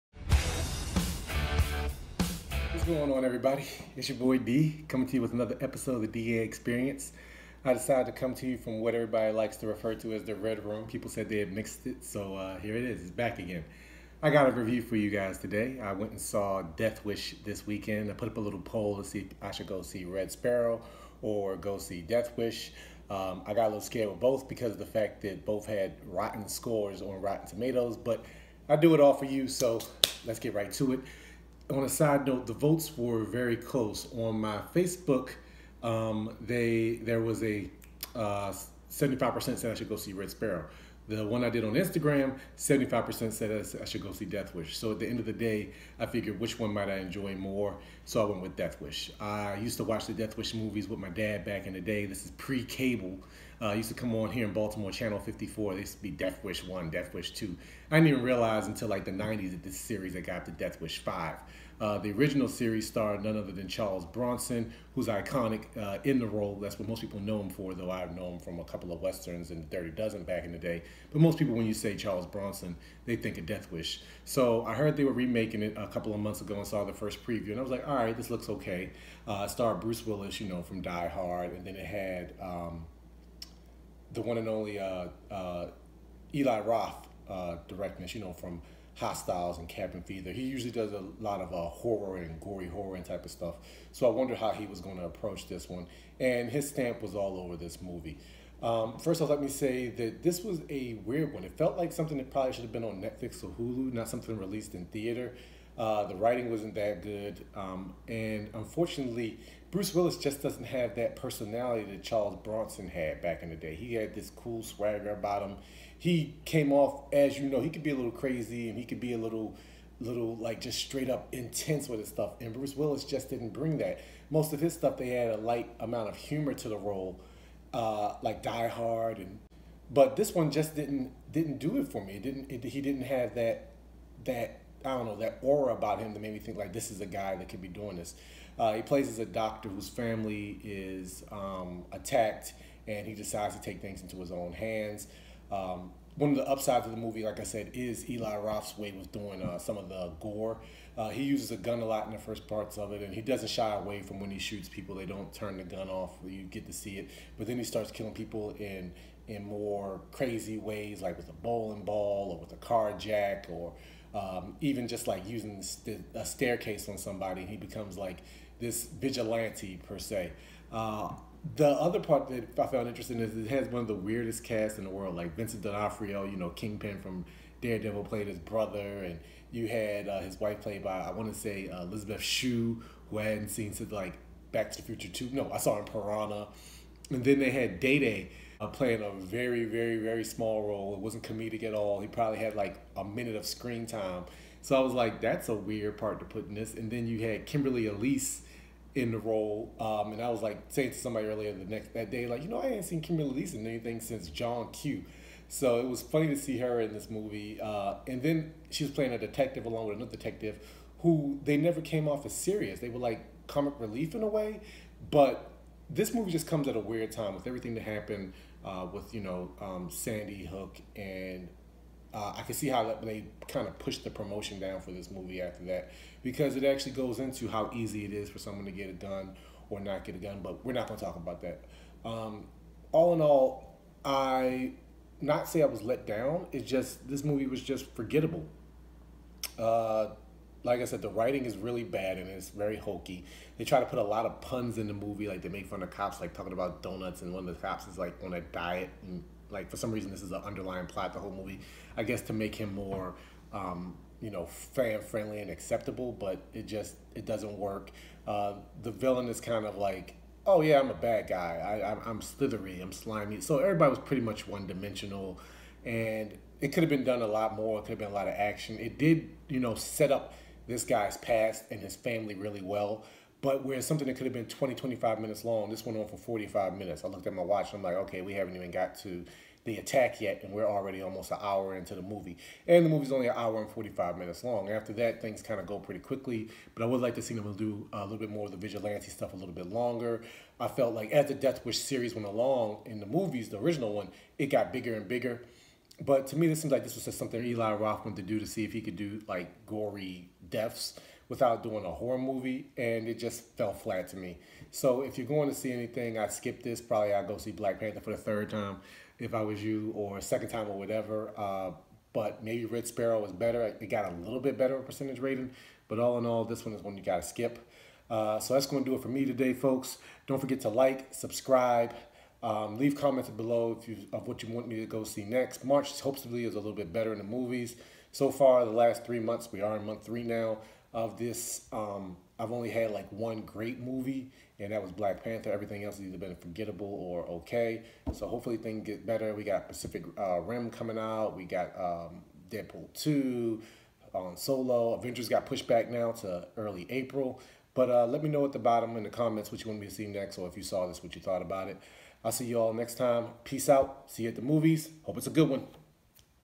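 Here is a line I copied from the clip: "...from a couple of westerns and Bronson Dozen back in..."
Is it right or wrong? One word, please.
wrong.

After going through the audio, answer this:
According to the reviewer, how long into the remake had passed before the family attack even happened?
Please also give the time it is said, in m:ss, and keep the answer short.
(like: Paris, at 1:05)
almost an hour, at 4:41.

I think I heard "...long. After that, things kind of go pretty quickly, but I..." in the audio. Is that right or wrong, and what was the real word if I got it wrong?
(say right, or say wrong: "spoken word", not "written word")
right.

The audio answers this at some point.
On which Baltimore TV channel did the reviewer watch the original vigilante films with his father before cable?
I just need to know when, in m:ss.
0:54.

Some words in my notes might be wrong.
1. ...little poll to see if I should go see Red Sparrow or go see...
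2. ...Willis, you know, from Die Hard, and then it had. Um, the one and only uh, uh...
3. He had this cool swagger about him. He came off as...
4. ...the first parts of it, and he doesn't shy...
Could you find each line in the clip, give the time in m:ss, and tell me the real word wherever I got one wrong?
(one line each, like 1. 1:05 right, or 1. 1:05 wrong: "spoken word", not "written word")
1. 0:18 right
2. 1:20 right
3. 1:53 right
4. 2:32 right.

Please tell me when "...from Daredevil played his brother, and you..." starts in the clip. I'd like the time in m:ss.
2:57.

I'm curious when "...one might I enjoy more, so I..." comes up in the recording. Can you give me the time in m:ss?
0:46.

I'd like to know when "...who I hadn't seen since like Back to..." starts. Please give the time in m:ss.
3:03.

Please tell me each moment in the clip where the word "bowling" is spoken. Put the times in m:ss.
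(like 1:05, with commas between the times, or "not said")
2:41.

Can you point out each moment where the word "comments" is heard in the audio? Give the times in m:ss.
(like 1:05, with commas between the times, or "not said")
5:22, 5:49.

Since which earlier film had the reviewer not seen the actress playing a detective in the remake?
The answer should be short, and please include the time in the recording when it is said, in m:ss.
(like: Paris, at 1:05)
John Q, at 3:24.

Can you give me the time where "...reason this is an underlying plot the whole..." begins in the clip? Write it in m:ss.
4:09.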